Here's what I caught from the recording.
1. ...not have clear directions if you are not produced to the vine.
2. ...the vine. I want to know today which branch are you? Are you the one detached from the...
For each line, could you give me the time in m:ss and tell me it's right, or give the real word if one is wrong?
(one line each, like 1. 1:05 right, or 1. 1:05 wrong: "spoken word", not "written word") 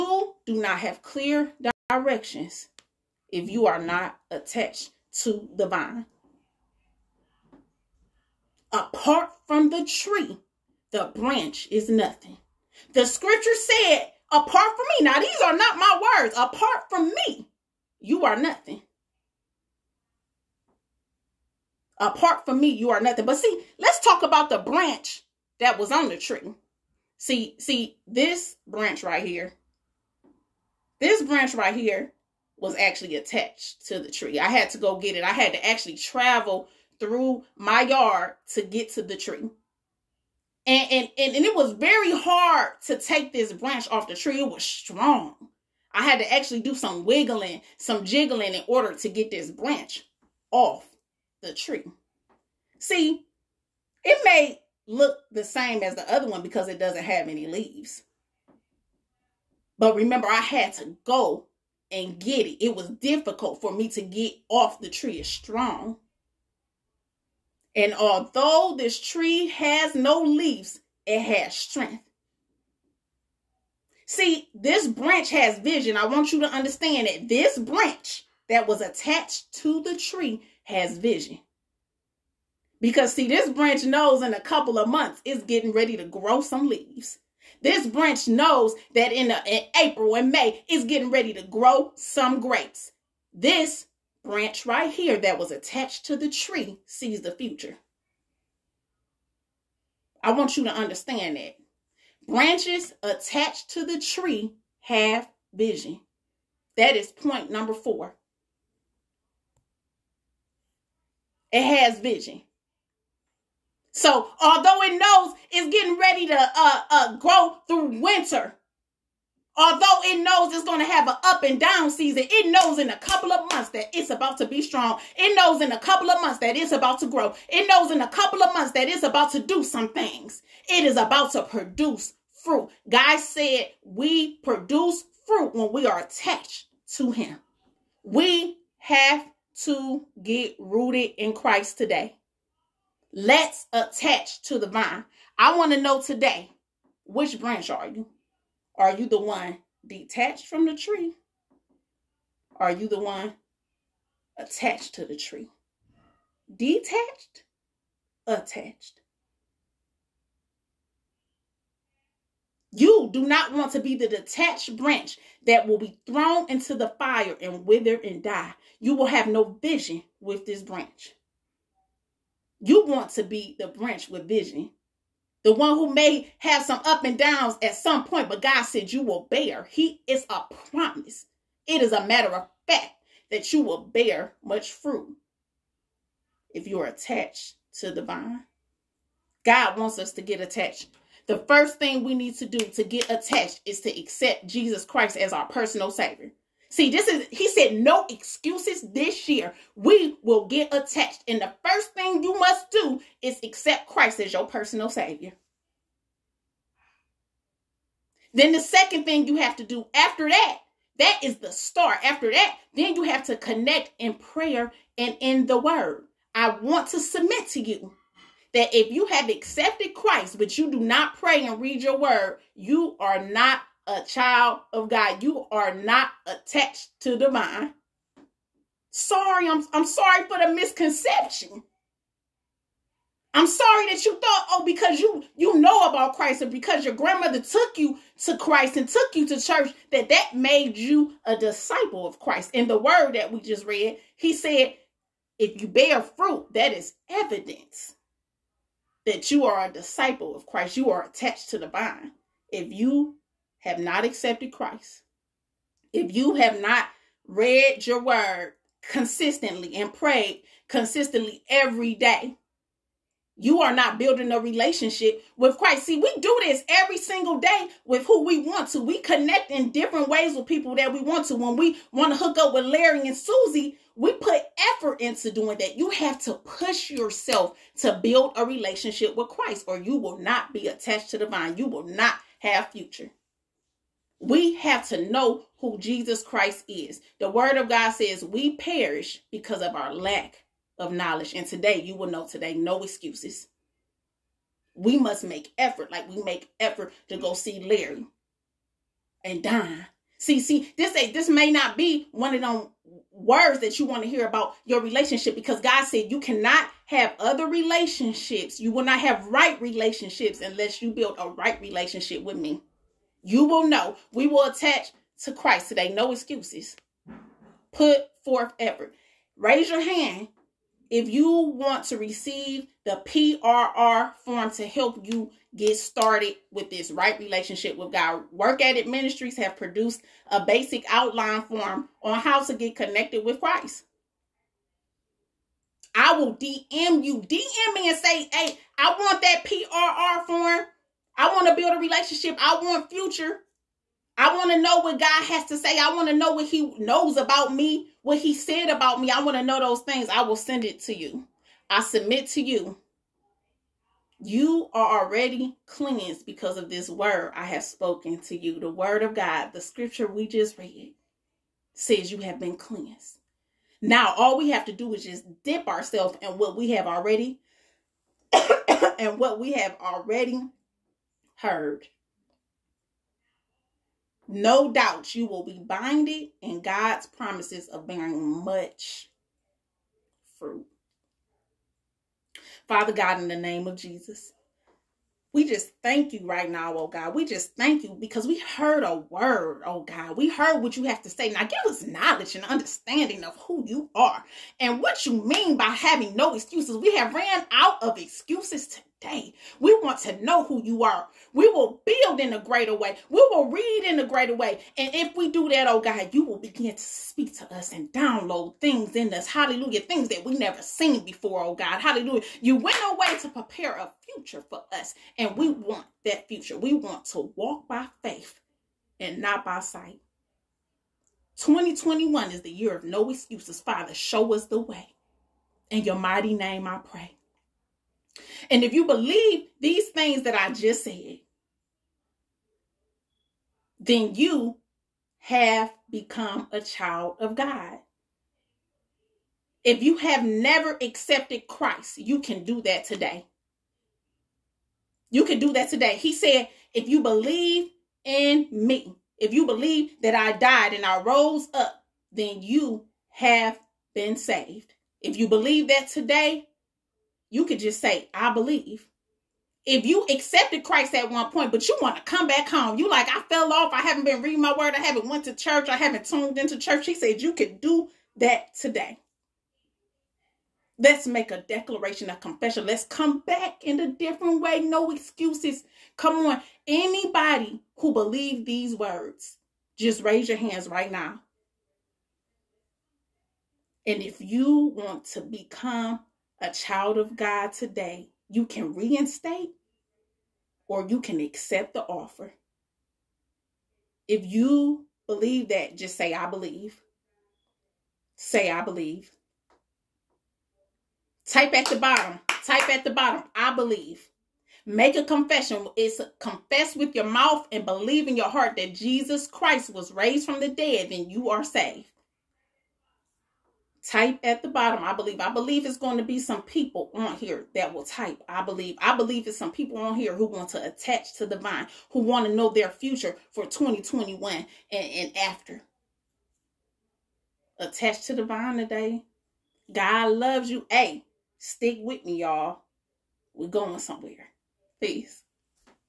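1. 0:00 wrong: "attached", not "produced"
2. 2:24 right.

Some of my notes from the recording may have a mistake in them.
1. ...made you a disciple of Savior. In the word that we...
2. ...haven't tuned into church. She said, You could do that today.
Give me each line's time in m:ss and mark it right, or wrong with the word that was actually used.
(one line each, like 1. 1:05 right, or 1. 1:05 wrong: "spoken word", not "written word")
1. 4:00 wrong: "Christ", not "Savior"
2. 7:45 right.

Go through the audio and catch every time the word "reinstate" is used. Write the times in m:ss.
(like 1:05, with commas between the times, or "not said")
8:08.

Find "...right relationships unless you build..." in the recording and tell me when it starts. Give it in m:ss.
5:09.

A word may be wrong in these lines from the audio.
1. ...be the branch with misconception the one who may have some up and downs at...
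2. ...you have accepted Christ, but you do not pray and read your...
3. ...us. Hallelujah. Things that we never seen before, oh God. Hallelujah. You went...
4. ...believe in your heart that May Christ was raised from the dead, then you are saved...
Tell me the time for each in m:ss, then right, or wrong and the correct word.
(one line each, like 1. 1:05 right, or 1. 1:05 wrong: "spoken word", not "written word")
1. 2:53 wrong: "vision", not "misconception"
2. 3:38 right
3. 6:49 right
4. 8:27 wrong: "Jesus", not "May".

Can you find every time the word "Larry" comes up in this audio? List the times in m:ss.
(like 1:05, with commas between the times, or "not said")
4:32, 4:57.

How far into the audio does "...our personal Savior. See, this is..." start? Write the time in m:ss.
3:15.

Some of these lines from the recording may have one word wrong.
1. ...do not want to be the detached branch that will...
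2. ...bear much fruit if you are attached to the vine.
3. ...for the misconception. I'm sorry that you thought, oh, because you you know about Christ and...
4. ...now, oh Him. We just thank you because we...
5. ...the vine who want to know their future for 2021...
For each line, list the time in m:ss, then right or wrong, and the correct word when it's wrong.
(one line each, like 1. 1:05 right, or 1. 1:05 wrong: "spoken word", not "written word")
1. 2:43 right
2. 3:03 right
3. 3:50 right
4. 6:26 wrong: "God", not "Him"
5. 8:41 right.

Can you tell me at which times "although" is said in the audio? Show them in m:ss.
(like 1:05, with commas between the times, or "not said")
1:07, 1:54, 1:59.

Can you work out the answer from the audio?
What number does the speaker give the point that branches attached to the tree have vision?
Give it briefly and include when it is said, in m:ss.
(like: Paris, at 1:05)
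4, at 1:47.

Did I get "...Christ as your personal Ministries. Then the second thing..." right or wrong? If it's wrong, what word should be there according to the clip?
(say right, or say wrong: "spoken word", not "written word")
wrong: "Savior", not "Ministries".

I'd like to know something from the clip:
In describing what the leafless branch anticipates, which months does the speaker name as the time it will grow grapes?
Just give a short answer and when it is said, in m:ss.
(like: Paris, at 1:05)
April and May, at 1:29.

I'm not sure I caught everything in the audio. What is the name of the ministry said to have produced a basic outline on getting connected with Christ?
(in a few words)
Work at It Ministries.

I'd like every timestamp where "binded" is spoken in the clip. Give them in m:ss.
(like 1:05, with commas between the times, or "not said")
6:15.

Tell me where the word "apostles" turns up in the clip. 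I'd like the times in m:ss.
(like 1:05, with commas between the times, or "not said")
not said.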